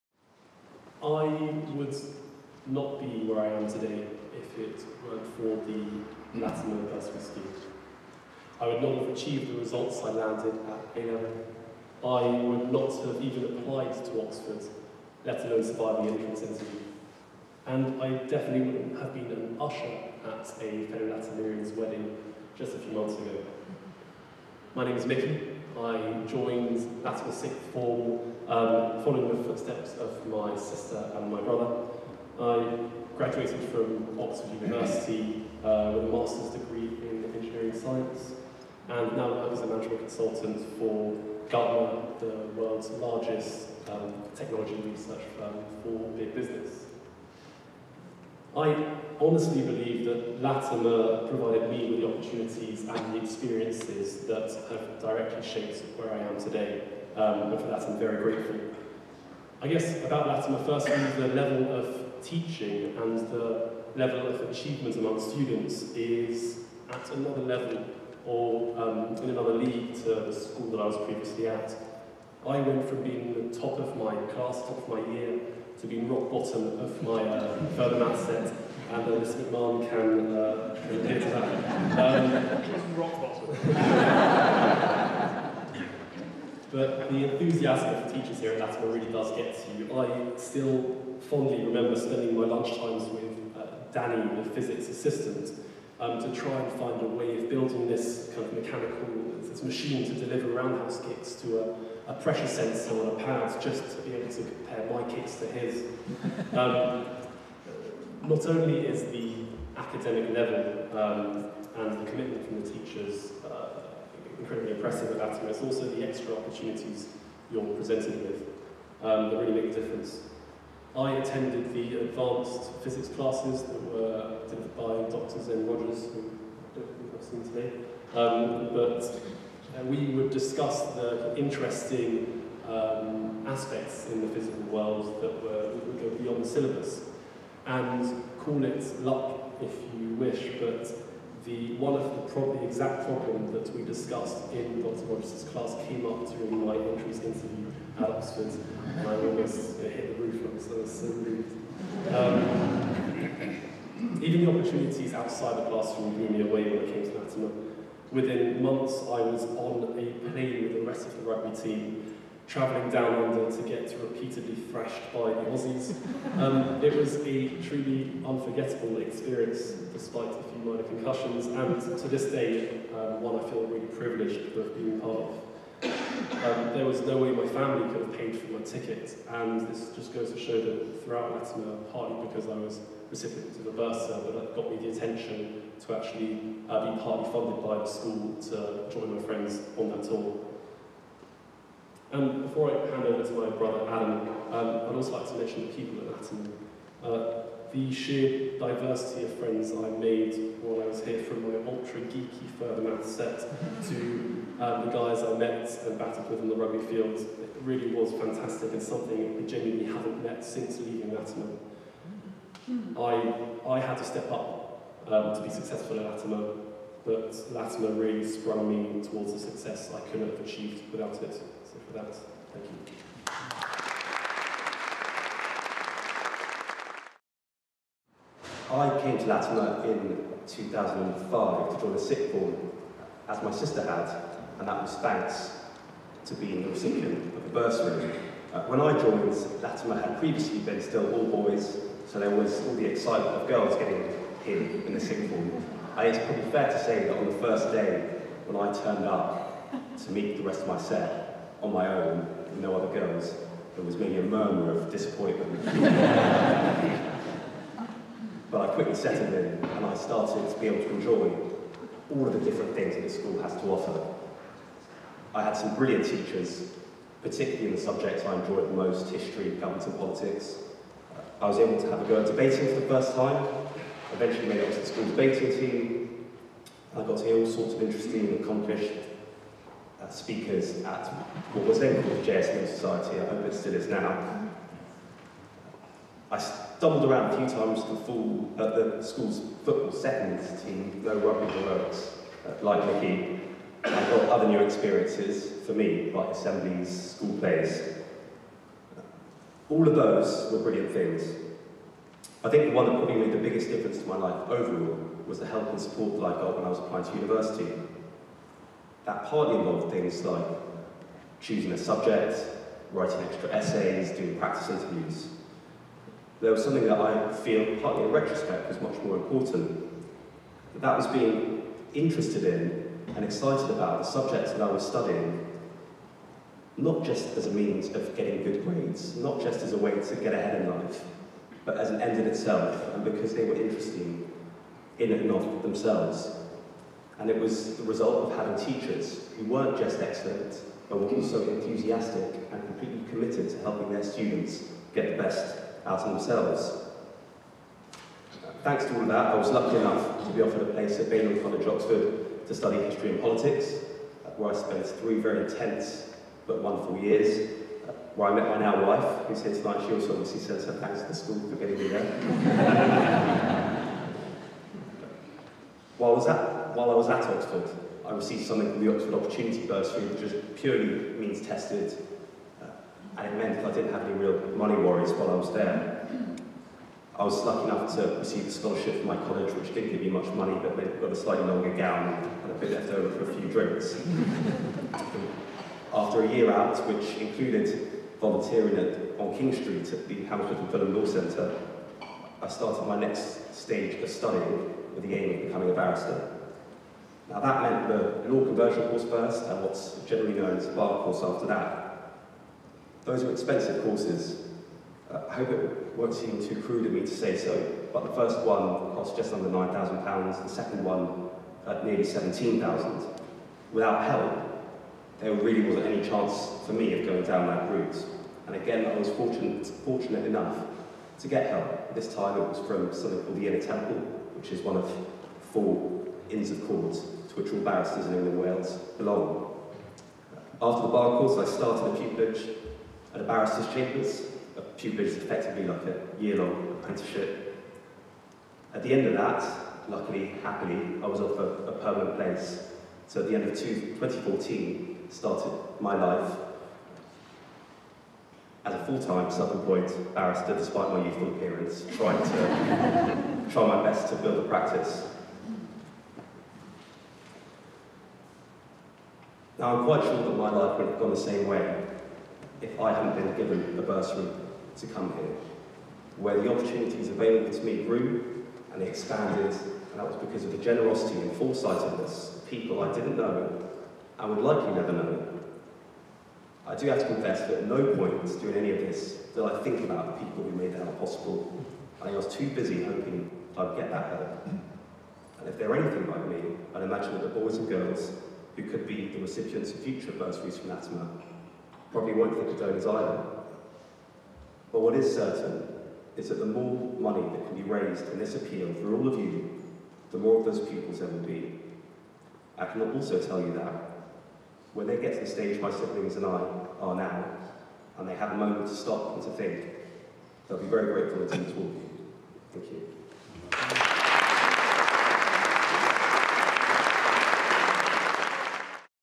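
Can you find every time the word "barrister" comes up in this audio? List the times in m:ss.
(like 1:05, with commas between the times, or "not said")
6:35, 7:07, 7:13, 7:30.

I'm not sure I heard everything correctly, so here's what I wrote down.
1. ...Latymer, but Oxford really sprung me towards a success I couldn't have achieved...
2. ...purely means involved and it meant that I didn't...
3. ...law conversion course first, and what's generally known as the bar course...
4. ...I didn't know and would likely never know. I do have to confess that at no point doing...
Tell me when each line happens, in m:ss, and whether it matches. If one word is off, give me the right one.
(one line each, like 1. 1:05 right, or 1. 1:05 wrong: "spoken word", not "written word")
1. 3:36 wrong: "Latymer", not "Oxford"
2. 6:10 wrong: "tested", not "involved"
3. 6:38 right
4. 7:52 right.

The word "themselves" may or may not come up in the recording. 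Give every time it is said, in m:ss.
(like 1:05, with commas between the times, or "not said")
5:35, 5:46.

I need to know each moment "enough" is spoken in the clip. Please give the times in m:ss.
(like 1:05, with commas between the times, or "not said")
5:49, 6:17, 7:00.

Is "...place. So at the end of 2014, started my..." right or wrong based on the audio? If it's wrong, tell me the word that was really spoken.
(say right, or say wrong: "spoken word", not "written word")
right.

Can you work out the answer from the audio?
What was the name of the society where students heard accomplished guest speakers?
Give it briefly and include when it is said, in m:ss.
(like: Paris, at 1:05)
JSM Society, at 4:42.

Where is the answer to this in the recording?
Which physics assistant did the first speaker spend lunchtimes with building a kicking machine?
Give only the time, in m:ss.
1:33.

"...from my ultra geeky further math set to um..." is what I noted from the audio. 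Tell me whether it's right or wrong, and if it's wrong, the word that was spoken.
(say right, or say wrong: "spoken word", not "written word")
right.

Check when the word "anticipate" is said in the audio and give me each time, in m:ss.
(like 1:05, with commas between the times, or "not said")
not said.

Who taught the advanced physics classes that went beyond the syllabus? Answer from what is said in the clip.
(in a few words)
Dr. Zen Rogers.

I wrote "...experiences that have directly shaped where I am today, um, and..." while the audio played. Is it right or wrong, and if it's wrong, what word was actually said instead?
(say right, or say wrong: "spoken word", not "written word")
right.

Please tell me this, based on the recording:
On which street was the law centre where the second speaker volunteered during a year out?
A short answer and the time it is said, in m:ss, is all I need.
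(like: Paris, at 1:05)
King Street, at 6:29.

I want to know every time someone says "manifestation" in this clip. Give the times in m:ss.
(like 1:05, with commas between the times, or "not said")
not said.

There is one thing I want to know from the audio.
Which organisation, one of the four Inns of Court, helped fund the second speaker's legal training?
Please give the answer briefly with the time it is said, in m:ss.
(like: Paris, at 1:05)
Inner Temple, at 7:03.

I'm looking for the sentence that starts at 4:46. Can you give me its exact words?
I doubled around a few times the, full, at the school's football seconds team, no rugby or works, uh, like Mickey.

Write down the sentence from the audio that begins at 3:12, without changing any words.
And um, before I hand over to my brother Adam, um, I'd also like to mention the people at Latymer.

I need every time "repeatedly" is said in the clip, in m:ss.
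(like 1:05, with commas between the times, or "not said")
2:44.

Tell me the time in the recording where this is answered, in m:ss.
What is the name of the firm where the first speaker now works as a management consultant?
0:41.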